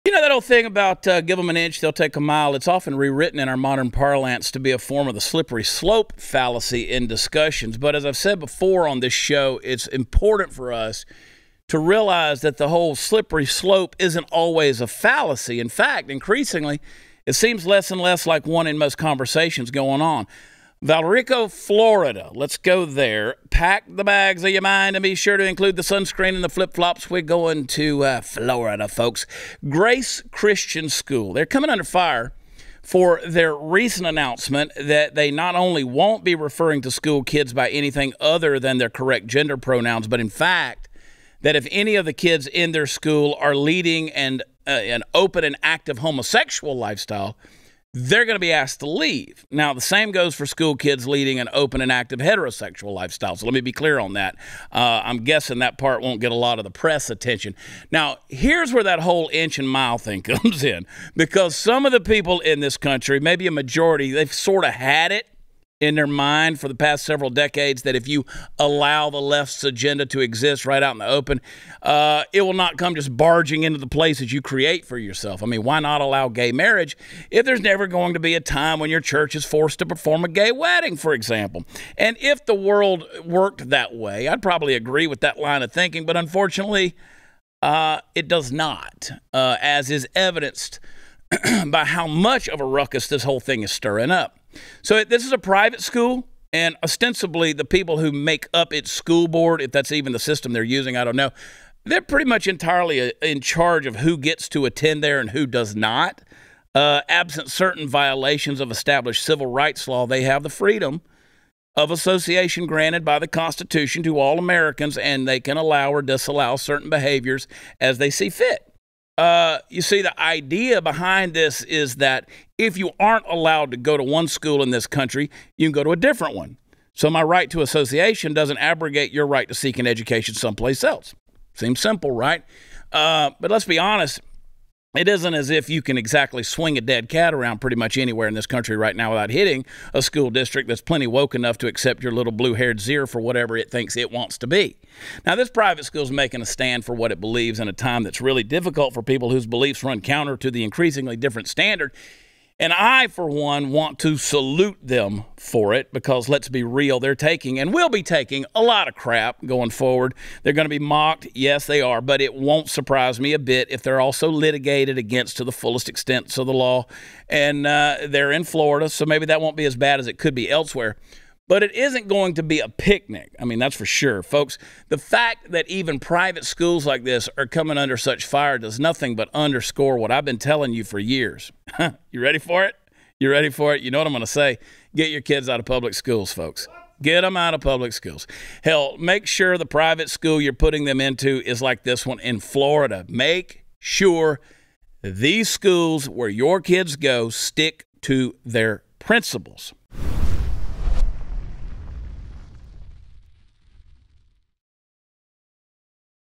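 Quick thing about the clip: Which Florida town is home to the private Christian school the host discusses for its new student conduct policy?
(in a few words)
Valrico.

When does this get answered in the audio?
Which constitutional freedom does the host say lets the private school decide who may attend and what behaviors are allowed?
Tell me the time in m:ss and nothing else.
1:50.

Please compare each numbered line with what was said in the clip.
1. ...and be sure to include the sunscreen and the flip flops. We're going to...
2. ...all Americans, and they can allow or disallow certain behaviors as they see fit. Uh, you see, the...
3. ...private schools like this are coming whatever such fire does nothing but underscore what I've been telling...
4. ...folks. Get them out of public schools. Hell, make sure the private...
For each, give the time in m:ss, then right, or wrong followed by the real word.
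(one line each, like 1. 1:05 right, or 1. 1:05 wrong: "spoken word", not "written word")
1. 0:24 right
2. 1:54 right
3. 2:55 wrong: "under", not "whatever"
4. 3:06 right.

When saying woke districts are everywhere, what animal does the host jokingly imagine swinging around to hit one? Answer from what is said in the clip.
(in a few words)
dead cat.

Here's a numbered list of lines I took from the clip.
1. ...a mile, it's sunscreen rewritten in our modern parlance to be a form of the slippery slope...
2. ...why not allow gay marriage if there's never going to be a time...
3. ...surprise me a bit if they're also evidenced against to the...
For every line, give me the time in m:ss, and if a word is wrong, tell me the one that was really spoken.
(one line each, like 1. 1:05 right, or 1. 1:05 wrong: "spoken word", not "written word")
1. 0:02 wrong: "often", not "sunscreen"
2. 1:15 right
3. 2:42 wrong: "litigated", not "evidenced".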